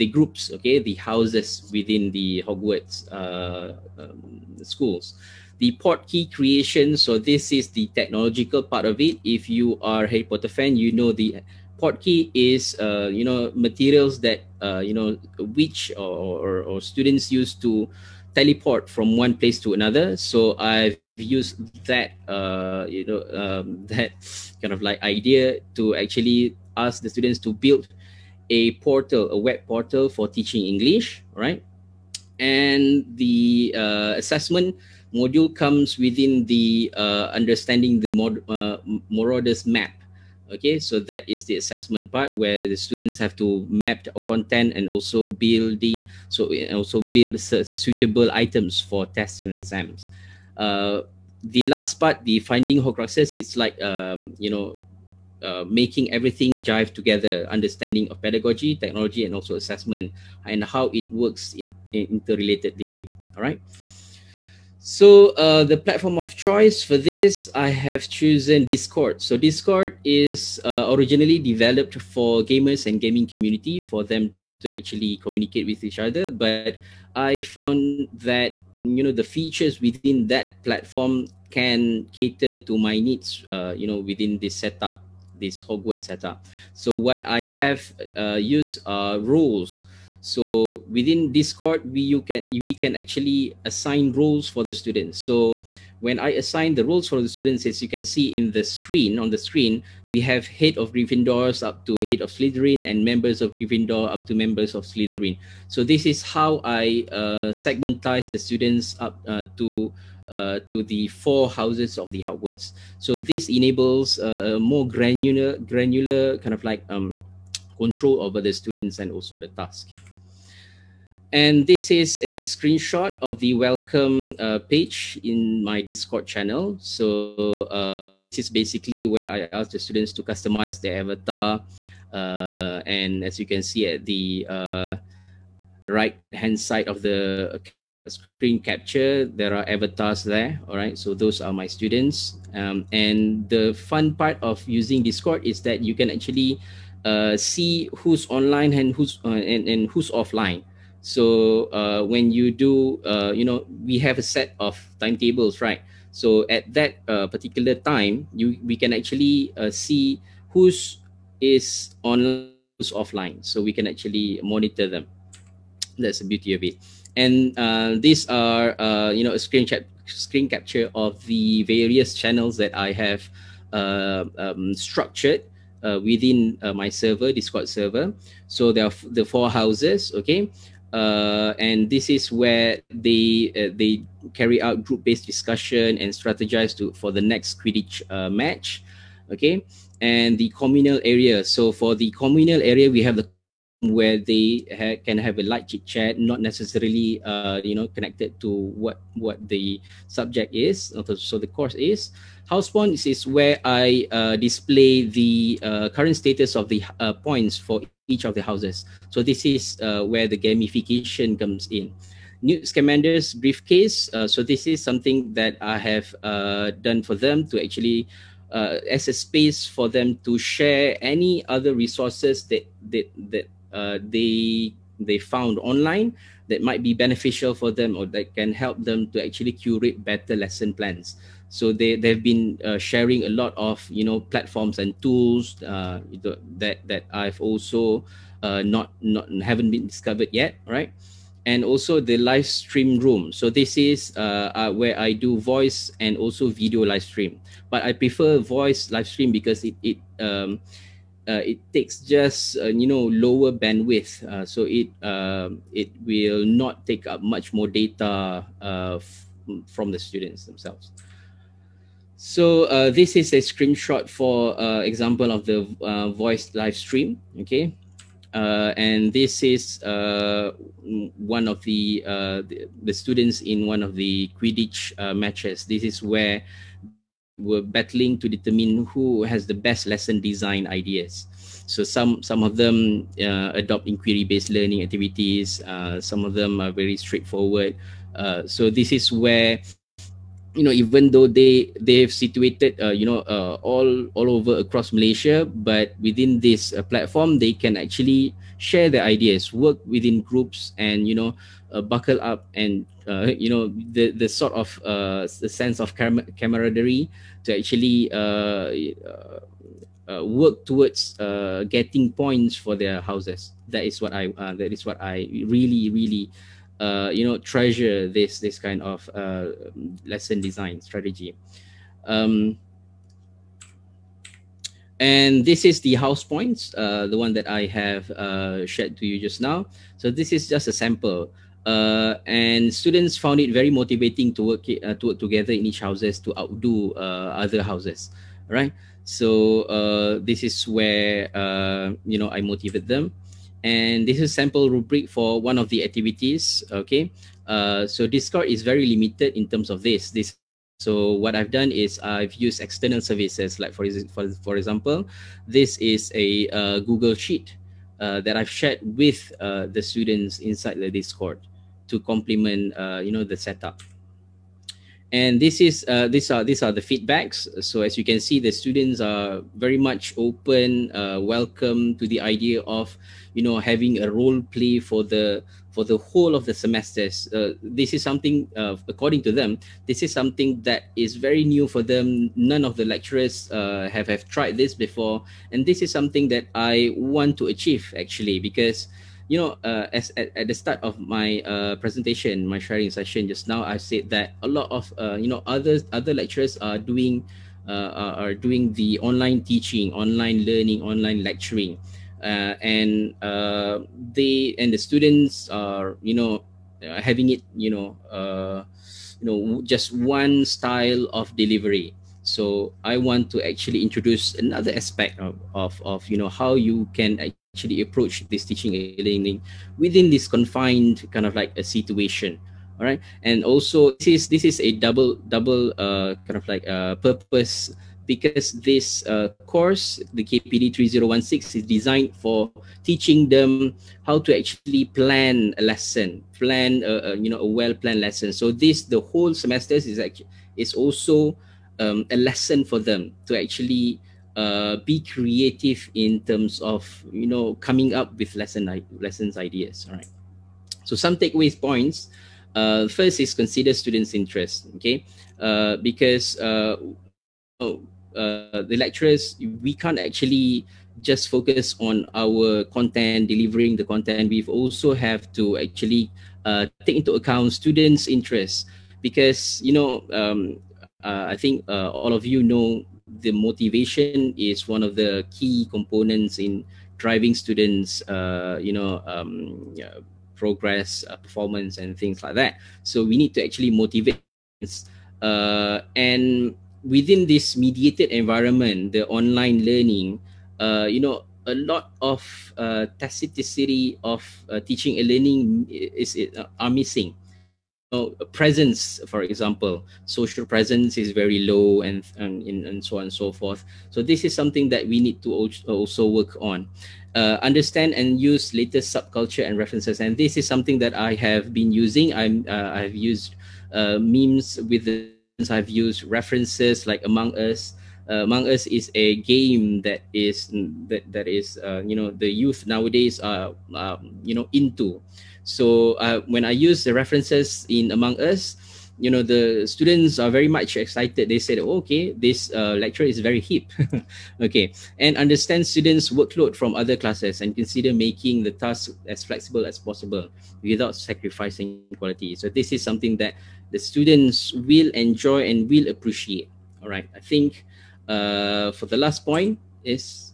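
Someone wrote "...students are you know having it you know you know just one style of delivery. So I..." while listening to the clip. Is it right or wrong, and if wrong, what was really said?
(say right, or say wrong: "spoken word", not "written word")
right.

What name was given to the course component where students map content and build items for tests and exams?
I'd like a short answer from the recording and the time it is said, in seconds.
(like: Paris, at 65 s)
Marauders map, at 39 s.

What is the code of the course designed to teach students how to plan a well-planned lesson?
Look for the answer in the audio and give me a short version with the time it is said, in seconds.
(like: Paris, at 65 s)
KPD 3016, at 430 s.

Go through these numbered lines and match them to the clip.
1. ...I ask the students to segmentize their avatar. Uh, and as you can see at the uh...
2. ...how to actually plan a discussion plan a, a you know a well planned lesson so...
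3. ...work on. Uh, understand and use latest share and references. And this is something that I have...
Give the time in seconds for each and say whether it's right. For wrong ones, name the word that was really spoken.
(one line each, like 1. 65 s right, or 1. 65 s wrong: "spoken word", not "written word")
1. 129 s wrong: "customize", not "segmentize"
2. 434 s wrong: "lesson", not "discussion"
3. 506 s wrong: "subculture", not "share".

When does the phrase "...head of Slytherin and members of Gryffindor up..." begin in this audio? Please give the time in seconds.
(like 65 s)
102 s.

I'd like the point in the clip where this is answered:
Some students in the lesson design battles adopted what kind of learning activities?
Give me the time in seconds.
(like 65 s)
283 s.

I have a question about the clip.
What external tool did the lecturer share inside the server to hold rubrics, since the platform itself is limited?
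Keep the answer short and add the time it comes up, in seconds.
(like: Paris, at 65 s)
Google Sheet, at 356 s.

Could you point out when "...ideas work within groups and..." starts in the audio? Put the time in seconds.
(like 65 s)
299 s.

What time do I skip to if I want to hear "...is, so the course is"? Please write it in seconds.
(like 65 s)
200 s.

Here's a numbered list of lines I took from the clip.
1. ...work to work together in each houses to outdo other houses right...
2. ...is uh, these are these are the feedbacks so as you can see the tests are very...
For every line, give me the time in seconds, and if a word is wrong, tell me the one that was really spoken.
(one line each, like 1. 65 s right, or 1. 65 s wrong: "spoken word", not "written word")
1. 334 s right
2. 365 s wrong: "students", not "tests".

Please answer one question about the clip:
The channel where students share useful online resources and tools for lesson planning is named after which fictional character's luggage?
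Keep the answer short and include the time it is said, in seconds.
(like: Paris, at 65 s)
Newt Scamander's briefcase, at 212 s.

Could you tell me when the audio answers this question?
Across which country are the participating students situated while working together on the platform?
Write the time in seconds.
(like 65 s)
294 s.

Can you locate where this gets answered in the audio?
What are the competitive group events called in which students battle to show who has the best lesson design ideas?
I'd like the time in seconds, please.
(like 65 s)
274 s.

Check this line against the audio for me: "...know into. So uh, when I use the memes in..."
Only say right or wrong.
wrong.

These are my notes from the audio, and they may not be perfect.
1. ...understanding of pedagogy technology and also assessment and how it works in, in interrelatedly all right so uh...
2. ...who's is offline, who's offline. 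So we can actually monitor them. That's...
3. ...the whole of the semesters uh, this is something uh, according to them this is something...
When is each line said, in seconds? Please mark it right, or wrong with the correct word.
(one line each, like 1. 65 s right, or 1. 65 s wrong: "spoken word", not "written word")
1. 57 s right
2. 160 s wrong: "online", not "offline"
3. 375 s right.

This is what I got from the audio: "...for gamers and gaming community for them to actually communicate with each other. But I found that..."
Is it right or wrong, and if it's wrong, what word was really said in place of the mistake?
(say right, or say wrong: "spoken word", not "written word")
right.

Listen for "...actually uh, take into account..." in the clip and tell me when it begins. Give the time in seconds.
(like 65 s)
465 s.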